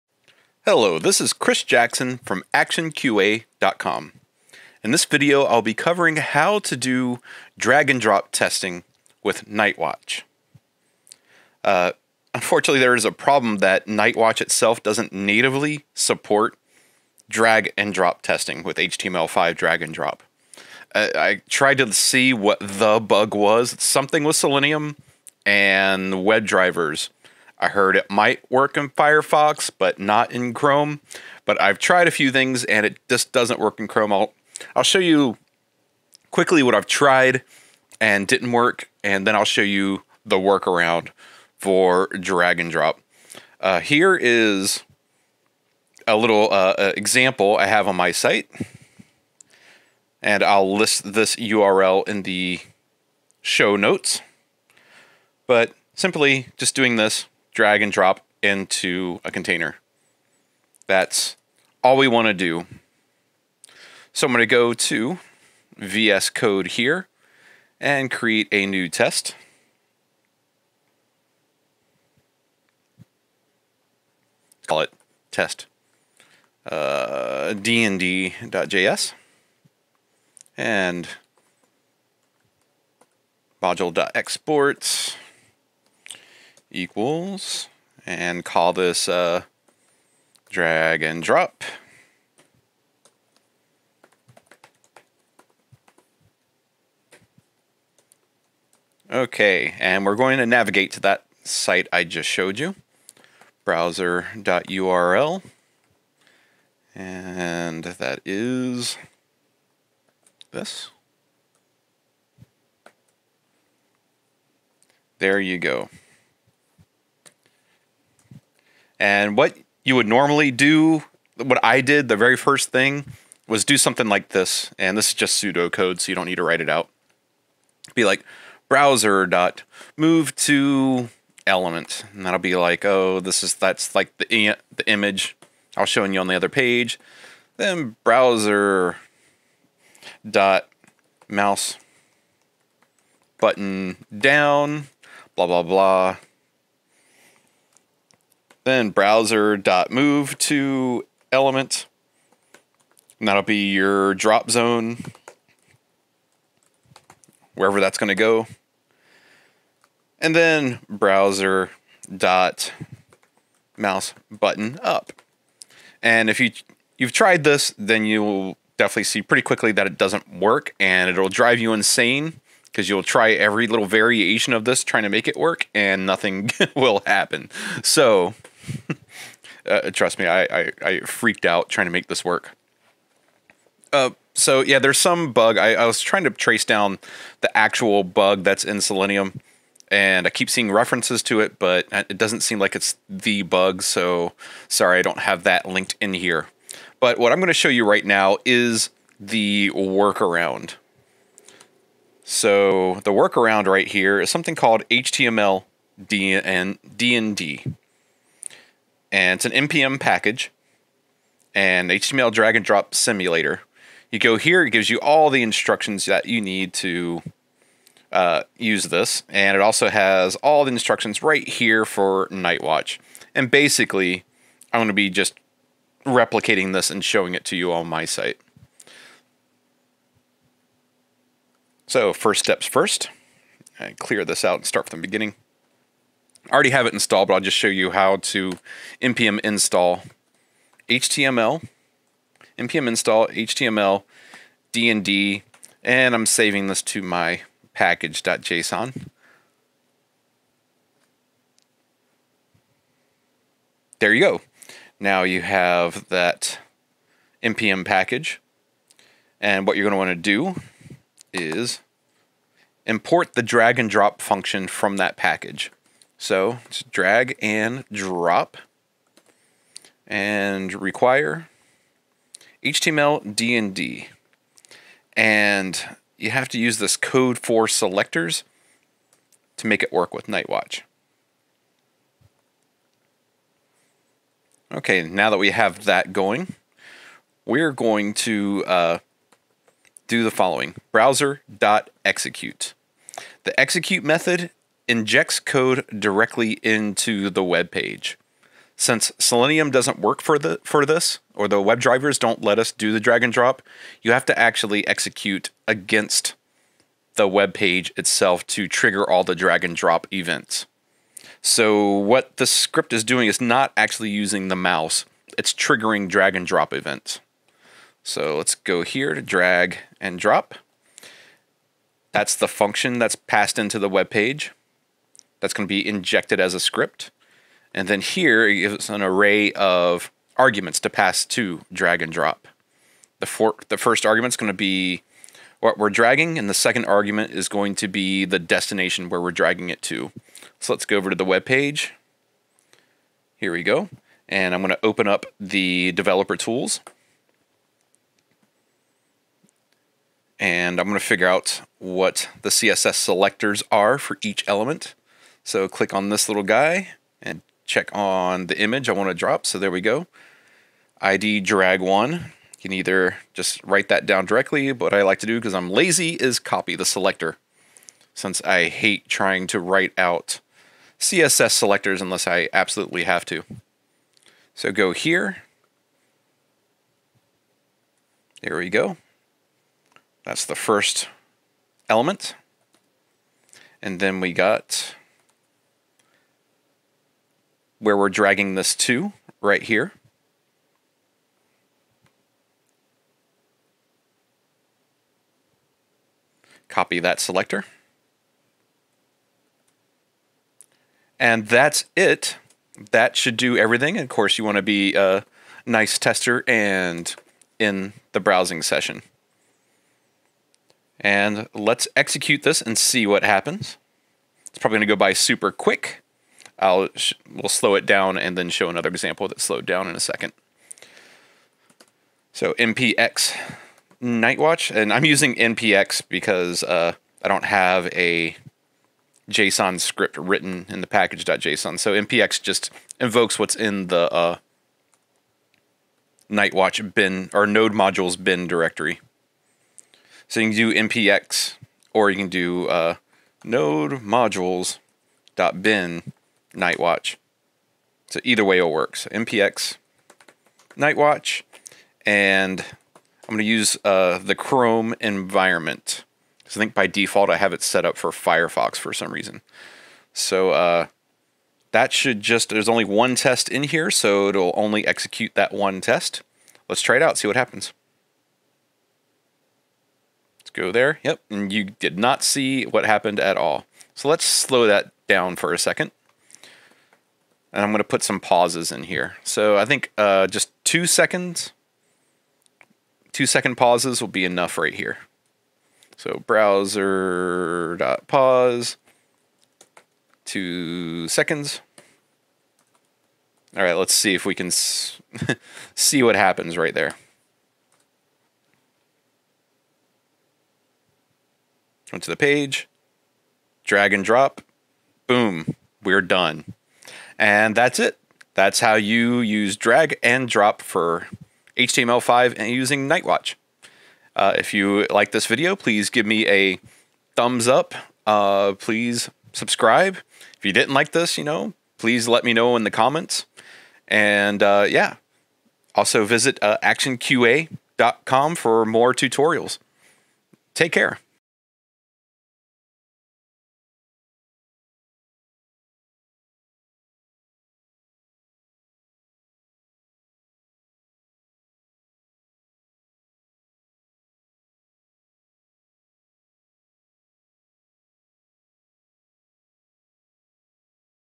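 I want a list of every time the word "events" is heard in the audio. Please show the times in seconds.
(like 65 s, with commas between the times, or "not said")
310 s, 316 s.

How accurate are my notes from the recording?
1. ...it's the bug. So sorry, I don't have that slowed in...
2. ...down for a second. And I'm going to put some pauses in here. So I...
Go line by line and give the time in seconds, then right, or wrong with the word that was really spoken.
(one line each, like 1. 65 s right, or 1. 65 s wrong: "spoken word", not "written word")
1. 192 s wrong: "linked", not "slowed"
2. 475 s right.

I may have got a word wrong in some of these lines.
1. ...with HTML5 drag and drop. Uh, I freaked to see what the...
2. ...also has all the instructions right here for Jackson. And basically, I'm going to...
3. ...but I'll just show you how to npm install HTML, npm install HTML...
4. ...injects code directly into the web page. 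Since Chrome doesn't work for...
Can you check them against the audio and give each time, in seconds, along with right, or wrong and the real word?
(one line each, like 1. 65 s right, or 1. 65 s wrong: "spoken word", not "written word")
1. 18 s wrong: "tried", not "freaked"
2. 219 s wrong: "Nightwatch", not "Jackson"
3. 237 s right
4. 294 s wrong: "Selenium", not "Chrome".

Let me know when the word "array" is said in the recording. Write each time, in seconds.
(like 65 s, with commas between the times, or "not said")
329 s.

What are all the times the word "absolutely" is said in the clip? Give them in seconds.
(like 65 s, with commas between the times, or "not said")
372 s.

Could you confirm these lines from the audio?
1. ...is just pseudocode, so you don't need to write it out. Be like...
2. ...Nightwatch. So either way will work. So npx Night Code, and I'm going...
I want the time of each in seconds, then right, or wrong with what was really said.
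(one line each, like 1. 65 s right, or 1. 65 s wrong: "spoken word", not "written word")
1. 125 s right
2. 446 s wrong: "Watch", not "Code".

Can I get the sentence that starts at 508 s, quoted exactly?
That's how you use drag and drop for HTML5 and using Nightwatch.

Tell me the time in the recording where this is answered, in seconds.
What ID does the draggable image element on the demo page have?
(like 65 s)
361 s.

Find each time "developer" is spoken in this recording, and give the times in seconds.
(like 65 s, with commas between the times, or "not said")
345 s.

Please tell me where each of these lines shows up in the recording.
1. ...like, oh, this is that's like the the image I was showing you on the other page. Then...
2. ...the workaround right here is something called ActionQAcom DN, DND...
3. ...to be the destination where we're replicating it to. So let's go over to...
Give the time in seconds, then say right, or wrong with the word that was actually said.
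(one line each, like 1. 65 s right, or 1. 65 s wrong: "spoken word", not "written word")
1. 132 s right
2. 203 s wrong: "HTML", not "ActionQAcom"
3. 337 s wrong: "dragging", not "replicating".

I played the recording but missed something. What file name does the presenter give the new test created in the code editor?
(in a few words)
dnd.js.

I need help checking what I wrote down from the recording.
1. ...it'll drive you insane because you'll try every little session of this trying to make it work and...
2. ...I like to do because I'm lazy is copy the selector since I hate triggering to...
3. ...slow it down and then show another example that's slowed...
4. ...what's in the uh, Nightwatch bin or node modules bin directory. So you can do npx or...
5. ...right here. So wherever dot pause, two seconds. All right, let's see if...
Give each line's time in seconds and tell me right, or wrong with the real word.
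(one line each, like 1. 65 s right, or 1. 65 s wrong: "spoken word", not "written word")
1. 171 s wrong: "variation", not "session"
2. 364 s wrong: "trying", not "triggering"
3. 417 s right
4. 433 s right
5. 484 s wrong: "browser", not "wherever".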